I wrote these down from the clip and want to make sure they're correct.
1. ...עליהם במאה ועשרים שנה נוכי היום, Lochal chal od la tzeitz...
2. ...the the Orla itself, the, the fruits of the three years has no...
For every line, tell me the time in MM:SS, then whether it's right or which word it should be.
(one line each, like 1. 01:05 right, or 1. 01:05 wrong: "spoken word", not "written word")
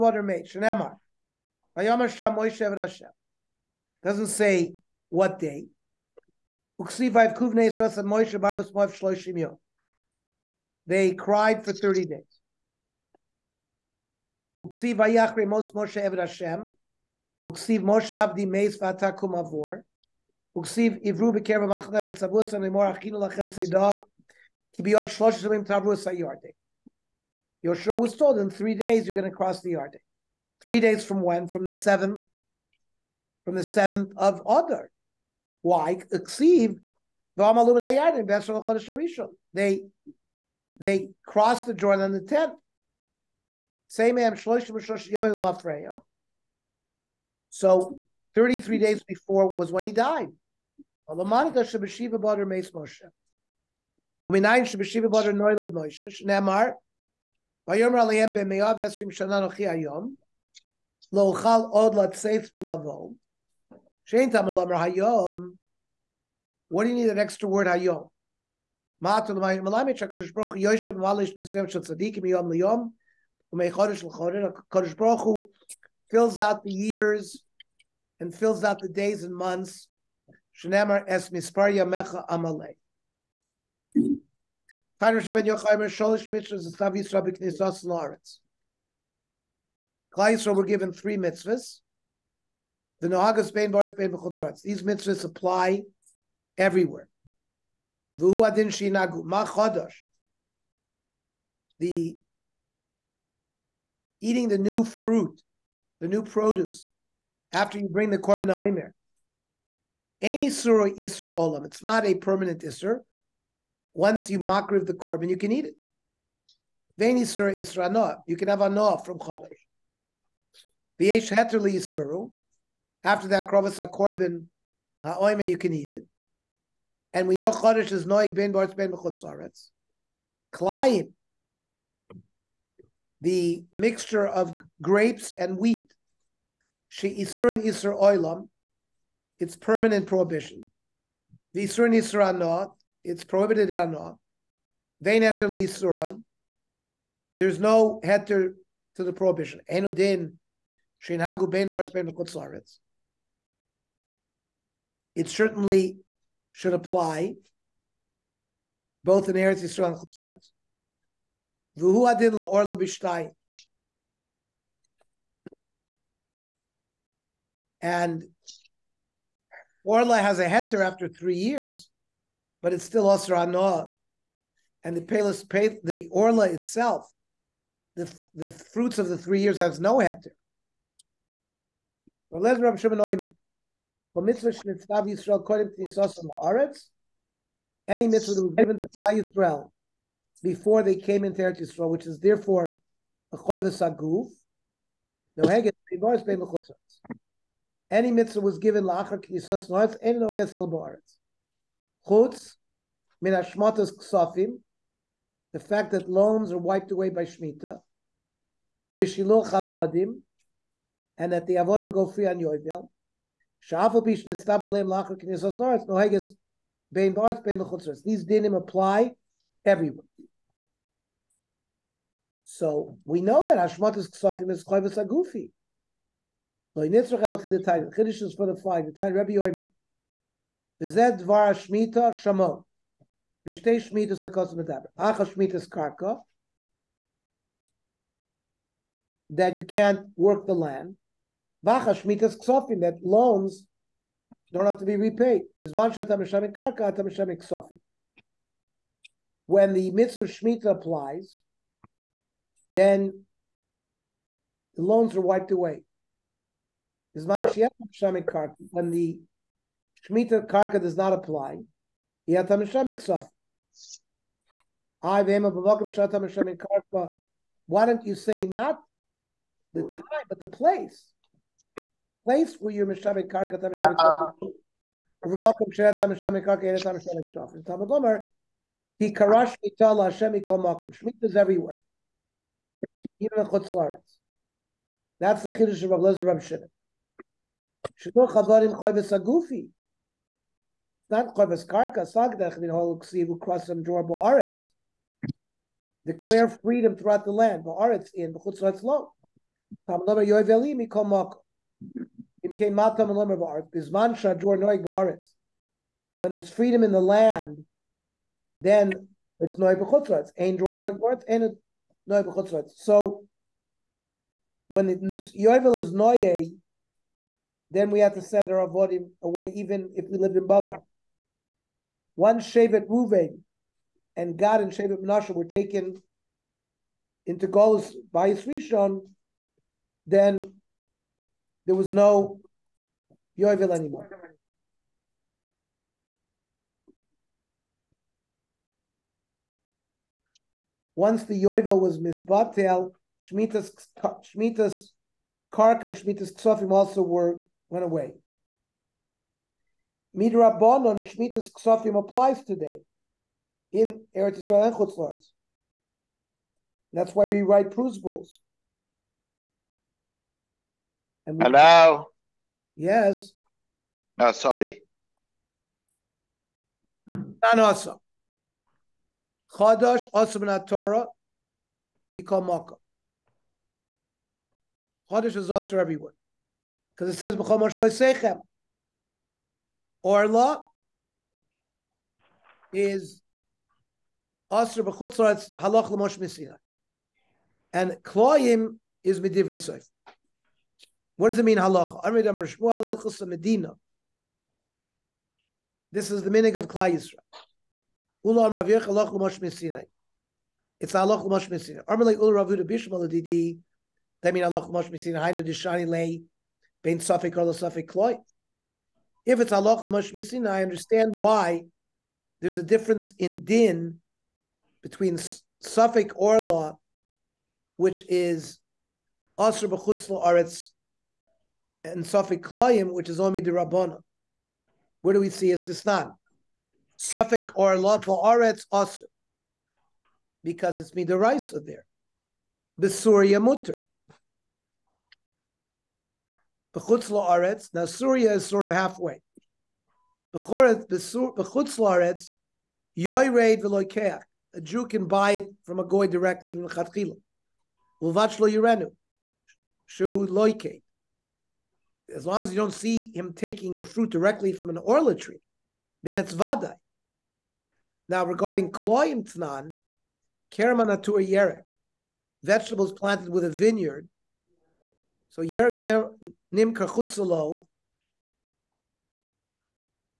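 1. 00:58 right
2. 02:54 right.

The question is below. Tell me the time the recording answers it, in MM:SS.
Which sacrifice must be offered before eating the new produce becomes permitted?
01:48.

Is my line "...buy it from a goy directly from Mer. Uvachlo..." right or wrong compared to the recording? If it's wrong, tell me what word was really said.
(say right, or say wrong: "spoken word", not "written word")
wrong: "Chatchila", not "Mer".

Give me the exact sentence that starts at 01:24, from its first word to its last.
Tanya Shem Ben Yochai Mer Sholish Mitzvah Zestav Yisrael B'Knesos L'Aretz.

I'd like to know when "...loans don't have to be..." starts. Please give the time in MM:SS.
04:03.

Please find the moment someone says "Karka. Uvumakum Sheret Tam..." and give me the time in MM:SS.
04:34.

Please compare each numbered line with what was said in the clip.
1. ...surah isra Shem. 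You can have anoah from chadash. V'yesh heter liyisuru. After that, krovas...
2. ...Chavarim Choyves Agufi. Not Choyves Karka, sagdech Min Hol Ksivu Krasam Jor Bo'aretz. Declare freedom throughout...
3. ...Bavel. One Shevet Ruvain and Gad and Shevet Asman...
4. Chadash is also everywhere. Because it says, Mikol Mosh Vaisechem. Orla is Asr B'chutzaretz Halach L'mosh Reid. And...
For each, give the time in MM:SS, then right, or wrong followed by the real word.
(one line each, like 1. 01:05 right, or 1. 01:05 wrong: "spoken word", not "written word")
1. 01:57 wrong: "Noah", not "Shem"
2. 04:48 right
3. 05:20 wrong: "Menashe", not "Asman"
4. 06:15 wrong: "Misinai", not "Reid".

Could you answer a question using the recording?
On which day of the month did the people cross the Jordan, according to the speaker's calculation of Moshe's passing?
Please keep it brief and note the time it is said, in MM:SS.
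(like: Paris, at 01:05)
the 10th, at 00:42.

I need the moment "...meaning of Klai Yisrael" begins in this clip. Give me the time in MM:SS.
06:36.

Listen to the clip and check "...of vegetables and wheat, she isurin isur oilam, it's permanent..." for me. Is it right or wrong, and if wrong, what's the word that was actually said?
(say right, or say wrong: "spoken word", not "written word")
wrong: "grapes", not "vegetables".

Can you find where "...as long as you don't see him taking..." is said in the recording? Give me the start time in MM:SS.
07:32.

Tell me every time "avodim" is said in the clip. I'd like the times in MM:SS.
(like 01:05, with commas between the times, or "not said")
03:31, 05:18.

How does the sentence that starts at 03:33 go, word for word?
Sha'afapish nistab aleim lachar kinesos noretz noheges bein ba'aretz bein mechutzres.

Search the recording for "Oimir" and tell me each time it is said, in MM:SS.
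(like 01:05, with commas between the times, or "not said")
03:02.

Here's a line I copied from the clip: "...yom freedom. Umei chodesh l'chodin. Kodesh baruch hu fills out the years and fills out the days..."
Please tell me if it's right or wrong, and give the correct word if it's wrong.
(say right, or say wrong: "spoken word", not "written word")
wrong: "liyom", not "freedom".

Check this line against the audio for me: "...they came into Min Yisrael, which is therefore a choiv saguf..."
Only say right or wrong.
wrong.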